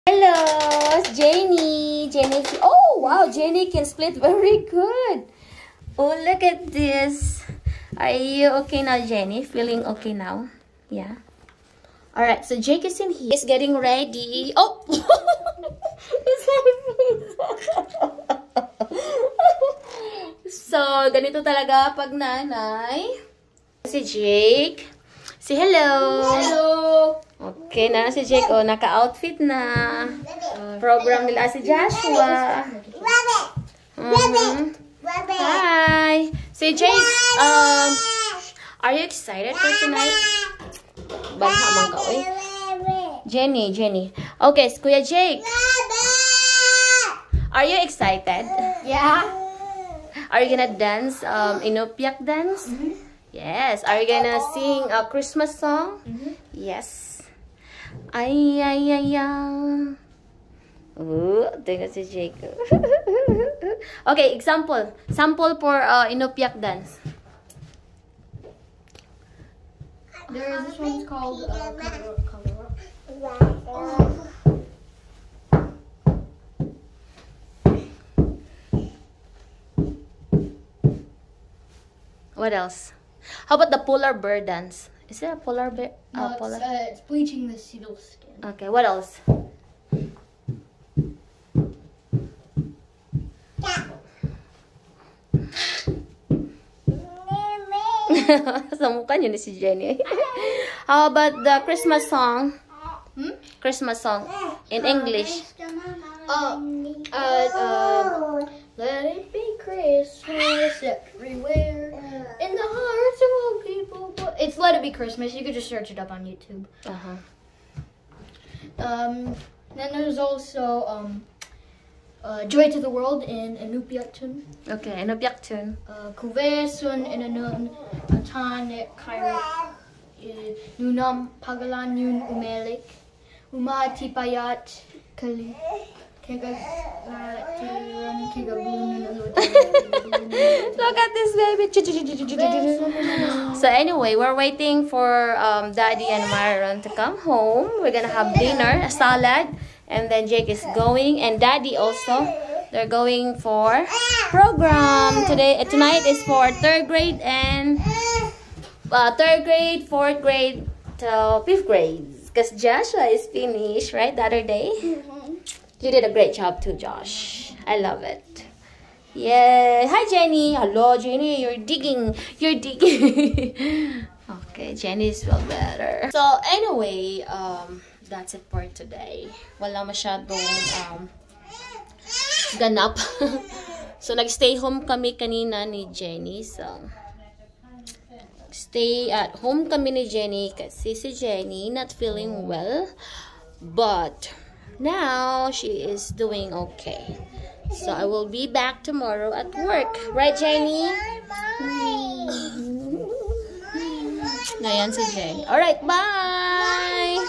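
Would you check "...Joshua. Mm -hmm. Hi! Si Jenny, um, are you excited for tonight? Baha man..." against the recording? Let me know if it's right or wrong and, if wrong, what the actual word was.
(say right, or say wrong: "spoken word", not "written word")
wrong: "Jake", not "Jenny".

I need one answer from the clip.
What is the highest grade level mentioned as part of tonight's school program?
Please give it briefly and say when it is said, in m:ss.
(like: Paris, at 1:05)
Fifth grade, at 2:41.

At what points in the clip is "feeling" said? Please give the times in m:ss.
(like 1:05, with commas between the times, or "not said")
0:09, 3:11.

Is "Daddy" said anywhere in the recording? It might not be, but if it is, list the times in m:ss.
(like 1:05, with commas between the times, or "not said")
2:25, 2:31.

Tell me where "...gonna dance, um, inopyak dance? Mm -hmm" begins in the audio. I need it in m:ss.
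0:50.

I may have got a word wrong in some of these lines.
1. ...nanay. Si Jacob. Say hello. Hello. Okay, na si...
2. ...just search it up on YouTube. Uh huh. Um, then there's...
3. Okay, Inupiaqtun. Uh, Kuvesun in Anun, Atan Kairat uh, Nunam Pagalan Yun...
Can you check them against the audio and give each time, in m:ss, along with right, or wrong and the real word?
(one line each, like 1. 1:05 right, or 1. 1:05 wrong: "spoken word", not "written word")
1. 0:22 wrong: "Jake", not "Jacob"
2. 1:55 right
3. 2:04 right.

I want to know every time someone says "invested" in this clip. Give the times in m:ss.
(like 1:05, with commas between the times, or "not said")
not said.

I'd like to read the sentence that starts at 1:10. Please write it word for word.
There is this one called uh, cover up, cover up.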